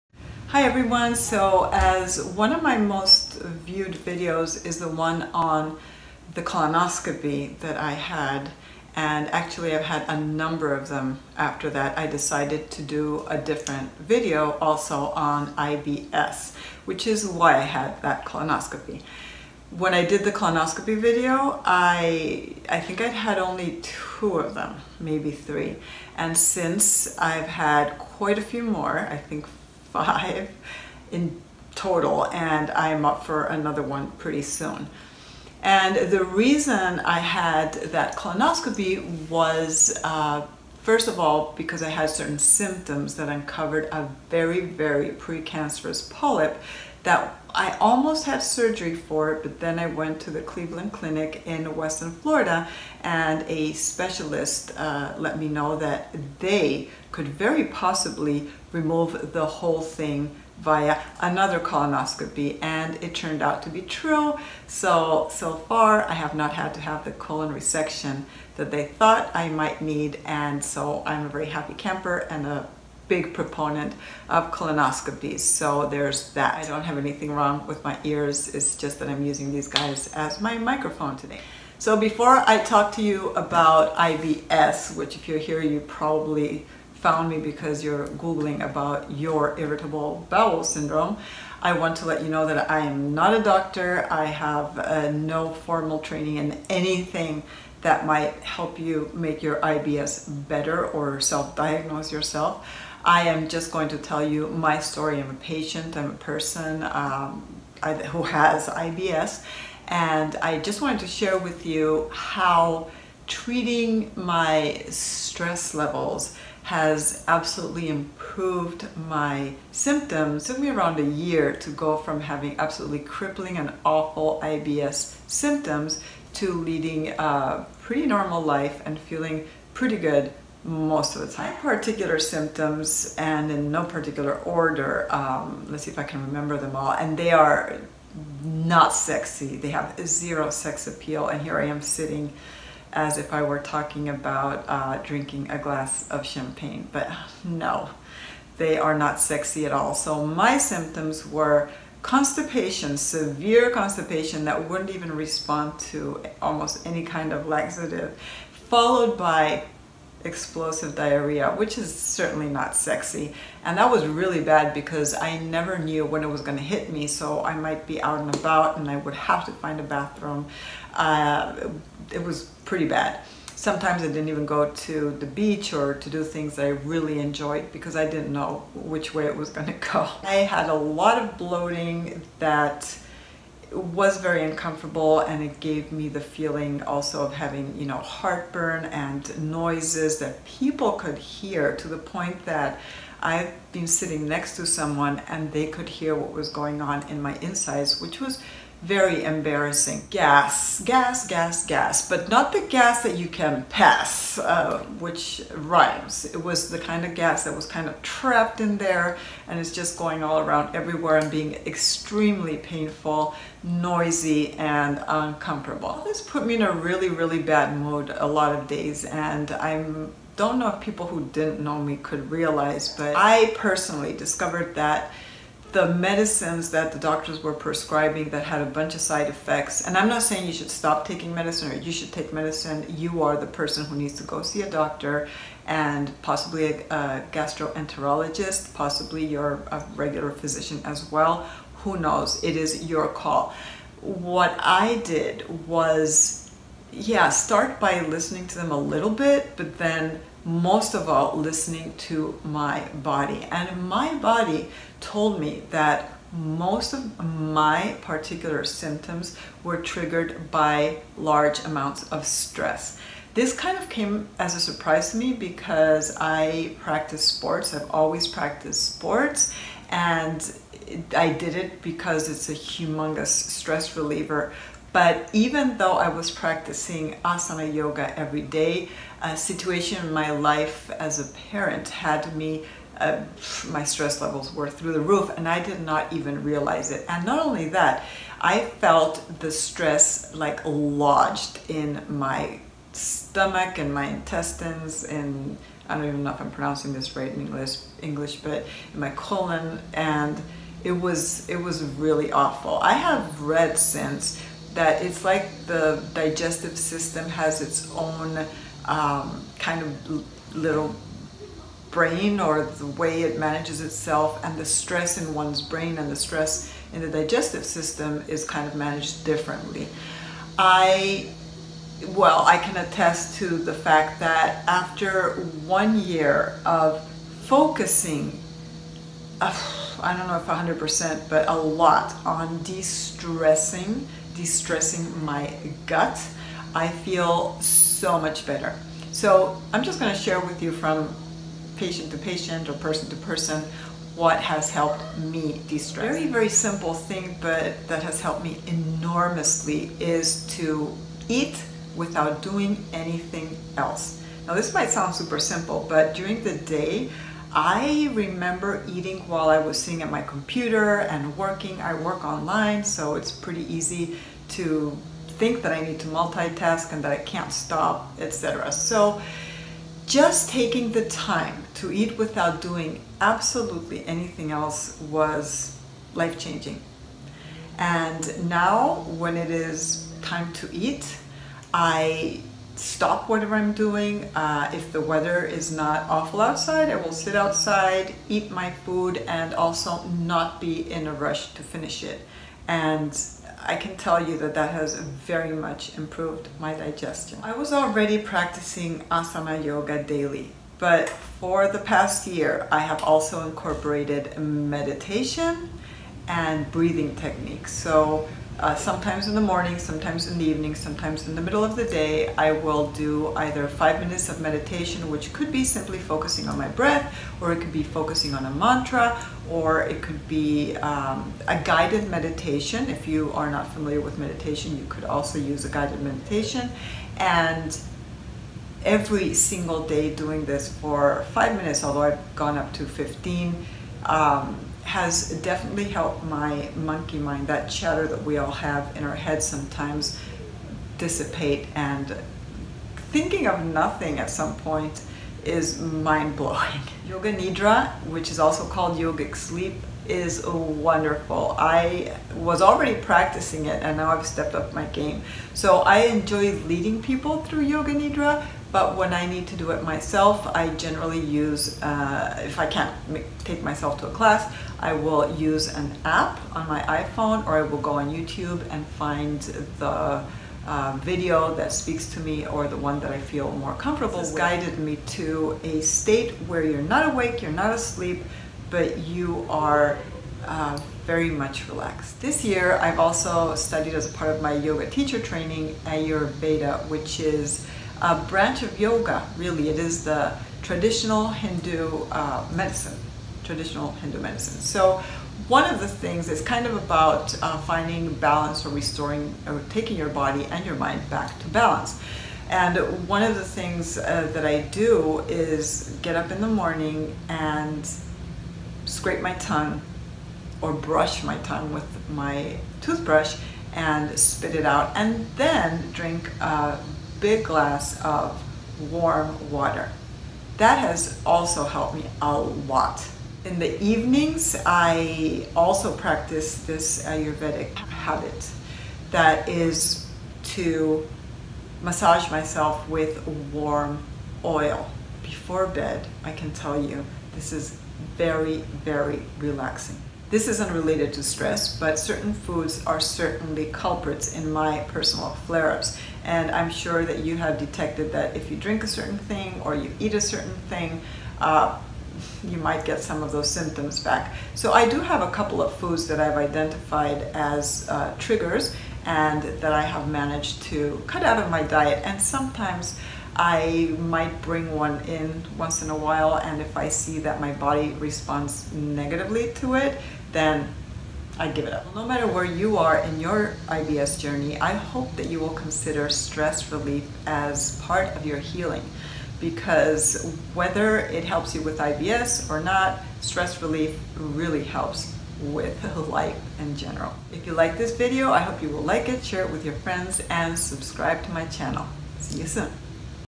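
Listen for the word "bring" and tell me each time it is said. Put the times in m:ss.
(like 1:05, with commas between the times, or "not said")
9:24.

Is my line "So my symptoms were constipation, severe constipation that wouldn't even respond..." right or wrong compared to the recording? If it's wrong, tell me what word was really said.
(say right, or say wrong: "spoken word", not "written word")
right.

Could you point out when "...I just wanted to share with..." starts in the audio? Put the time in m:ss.
1:50.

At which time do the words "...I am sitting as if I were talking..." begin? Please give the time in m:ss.
2:21.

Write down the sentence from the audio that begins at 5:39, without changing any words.
So I'm just going to share with you from patient to patient or person to person what has helped me de-stress.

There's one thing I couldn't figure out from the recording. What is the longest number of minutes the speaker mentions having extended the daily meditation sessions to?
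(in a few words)
15.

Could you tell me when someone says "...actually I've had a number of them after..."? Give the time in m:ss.
0:09.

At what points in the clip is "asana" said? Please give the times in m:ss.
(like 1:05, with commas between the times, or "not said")
4:37, 6:39.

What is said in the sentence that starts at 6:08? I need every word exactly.
So just taking the time to eat without doing absolutely anything else was life-changing.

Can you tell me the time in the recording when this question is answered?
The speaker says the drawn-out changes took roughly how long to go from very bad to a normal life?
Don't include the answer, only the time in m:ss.
2:00.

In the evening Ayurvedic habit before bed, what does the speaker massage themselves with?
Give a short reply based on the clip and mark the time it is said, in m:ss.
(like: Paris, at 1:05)
Warm oil, at 8:53.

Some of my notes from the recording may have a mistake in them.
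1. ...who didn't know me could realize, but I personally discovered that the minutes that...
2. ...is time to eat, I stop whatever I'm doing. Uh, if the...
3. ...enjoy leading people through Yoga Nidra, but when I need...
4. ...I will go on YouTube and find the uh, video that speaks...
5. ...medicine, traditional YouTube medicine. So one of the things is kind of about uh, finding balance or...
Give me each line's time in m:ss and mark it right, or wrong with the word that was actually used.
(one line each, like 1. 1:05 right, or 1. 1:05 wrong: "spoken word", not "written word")
1. 3:41 wrong: "medicines", not "minutes"
2. 6:19 right
3. 7:36 right
4. 7:47 right
5. 8:12 wrong: "Hindu", not "YouTube".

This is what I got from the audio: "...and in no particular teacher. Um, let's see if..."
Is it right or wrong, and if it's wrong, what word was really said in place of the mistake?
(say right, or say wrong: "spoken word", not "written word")
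wrong: "order", not "teacher".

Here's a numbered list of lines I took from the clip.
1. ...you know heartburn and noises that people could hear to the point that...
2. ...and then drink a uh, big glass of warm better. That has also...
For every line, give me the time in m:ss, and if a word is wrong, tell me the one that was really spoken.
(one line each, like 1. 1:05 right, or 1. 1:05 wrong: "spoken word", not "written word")
1. 3:07 right
2. 8:34 wrong: "water", not "better".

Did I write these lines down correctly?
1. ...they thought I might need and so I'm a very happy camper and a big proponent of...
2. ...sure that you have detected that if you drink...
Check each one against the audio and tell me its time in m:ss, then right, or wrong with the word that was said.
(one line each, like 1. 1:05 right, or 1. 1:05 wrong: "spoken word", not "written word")
1. 1:08 right
2. 9:06 right.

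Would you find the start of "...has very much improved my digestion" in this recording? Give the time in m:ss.
6:34.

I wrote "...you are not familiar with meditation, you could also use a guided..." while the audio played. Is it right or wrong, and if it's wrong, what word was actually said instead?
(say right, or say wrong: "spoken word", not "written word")
right.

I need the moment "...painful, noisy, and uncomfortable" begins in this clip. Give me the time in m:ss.
3:32.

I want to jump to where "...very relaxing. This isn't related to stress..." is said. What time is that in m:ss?
8:58.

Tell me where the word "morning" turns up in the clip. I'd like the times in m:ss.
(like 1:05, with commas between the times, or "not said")
6:49, 8:26.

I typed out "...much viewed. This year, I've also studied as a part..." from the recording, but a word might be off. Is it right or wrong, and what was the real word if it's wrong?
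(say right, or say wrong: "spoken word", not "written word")
wrong: "relaxed", not "viewed".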